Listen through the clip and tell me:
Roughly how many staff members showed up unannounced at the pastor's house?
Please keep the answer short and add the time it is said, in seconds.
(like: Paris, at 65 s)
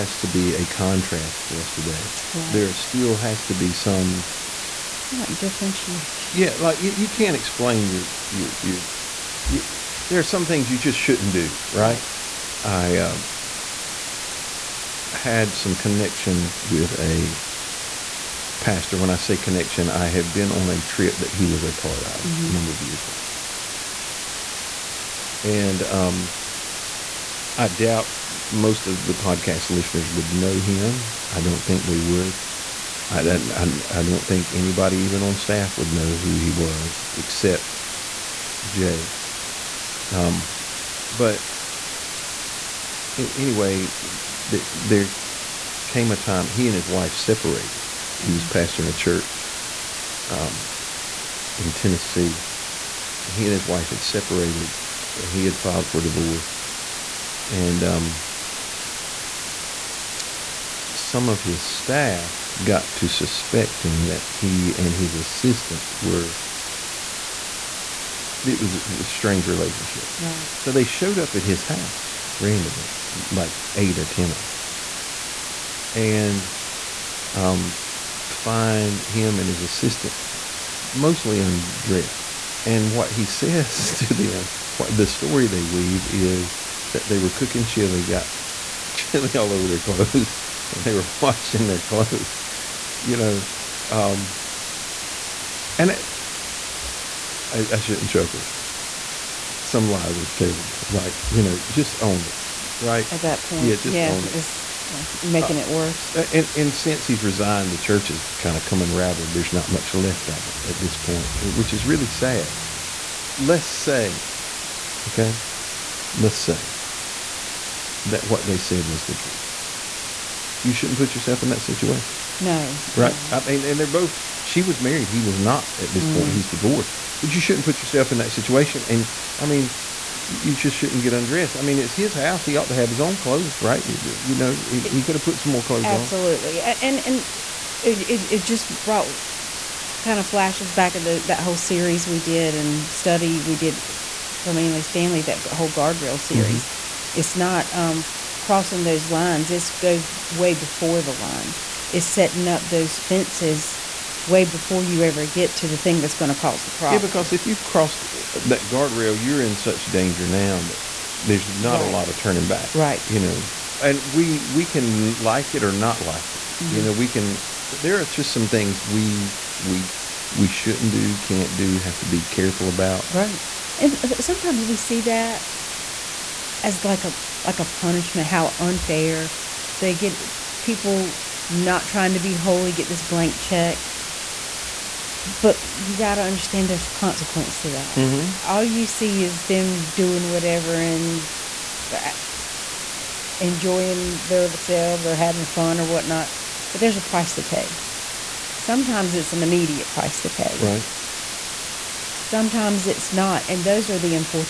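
8 or 10, at 73 s.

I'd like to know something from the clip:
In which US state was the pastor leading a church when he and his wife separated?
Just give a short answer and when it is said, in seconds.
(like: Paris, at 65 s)
Tennessee, at 51 s.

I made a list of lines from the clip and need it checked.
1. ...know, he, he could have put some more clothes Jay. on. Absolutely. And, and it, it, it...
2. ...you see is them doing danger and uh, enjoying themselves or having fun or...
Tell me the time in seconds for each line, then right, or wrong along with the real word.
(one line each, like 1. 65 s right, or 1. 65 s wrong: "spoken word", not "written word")
1. 134 s wrong: "Absolutely", not "Jay"
2. 188 s wrong: "whatever", not "danger".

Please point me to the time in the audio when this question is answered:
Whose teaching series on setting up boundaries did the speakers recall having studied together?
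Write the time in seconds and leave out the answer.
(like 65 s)
144 s.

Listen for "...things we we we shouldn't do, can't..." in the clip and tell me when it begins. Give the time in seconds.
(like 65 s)
168 s.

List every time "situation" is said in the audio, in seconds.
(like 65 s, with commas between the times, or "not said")
121 s, 128 s.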